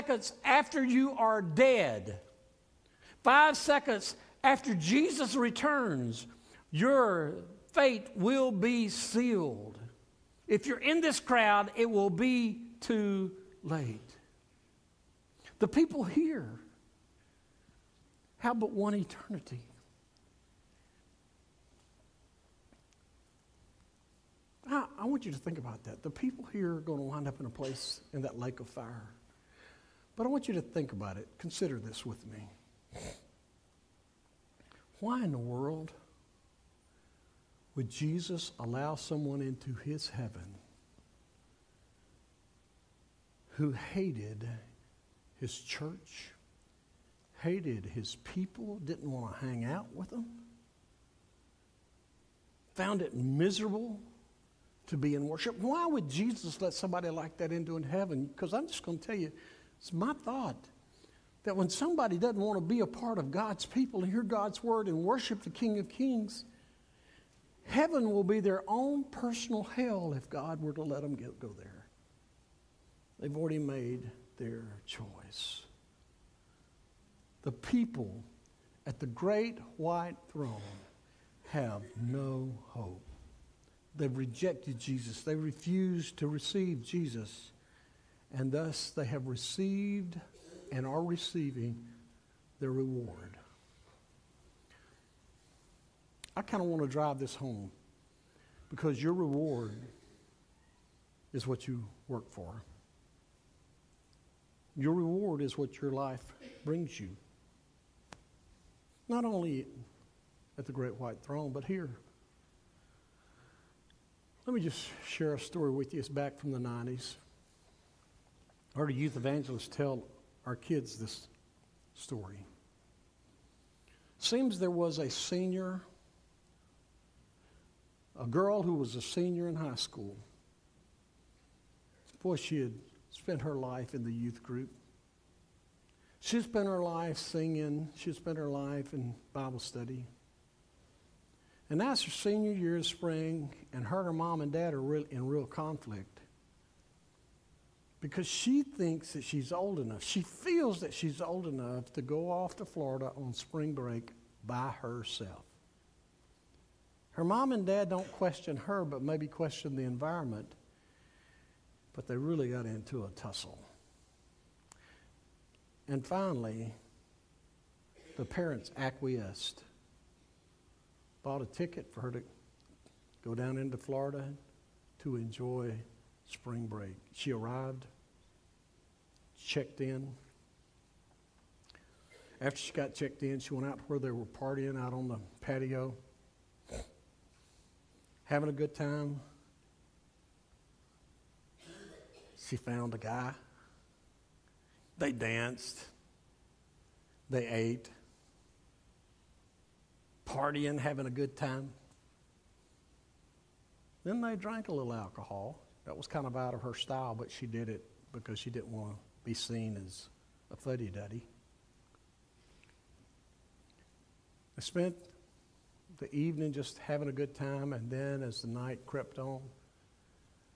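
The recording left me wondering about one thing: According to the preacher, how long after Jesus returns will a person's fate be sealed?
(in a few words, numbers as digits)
5 seconds.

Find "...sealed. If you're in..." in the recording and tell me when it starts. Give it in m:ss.
0:08.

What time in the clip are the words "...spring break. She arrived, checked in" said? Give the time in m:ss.
2:56.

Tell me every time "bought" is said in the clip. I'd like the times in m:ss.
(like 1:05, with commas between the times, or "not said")
2:51.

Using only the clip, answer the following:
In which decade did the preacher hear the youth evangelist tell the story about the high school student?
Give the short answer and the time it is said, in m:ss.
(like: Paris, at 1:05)
the 90s, at 1:56.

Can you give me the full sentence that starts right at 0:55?
Why would Jesus let somebody like that into heaven?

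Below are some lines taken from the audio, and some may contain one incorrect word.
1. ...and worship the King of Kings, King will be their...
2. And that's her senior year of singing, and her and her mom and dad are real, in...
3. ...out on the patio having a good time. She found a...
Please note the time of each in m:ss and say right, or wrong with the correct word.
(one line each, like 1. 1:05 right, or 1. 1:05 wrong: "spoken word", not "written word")
1. 1:04 wrong: "Heaven", not "King"
2. 2:21 wrong: "spring", not "singing"
3. 3:04 right.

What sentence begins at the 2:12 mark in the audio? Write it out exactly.
Boy, she had spent her life in the youth group.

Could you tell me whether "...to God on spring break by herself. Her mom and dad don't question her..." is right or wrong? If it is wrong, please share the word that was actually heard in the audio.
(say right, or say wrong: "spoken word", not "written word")
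wrong: "Florida", not "God".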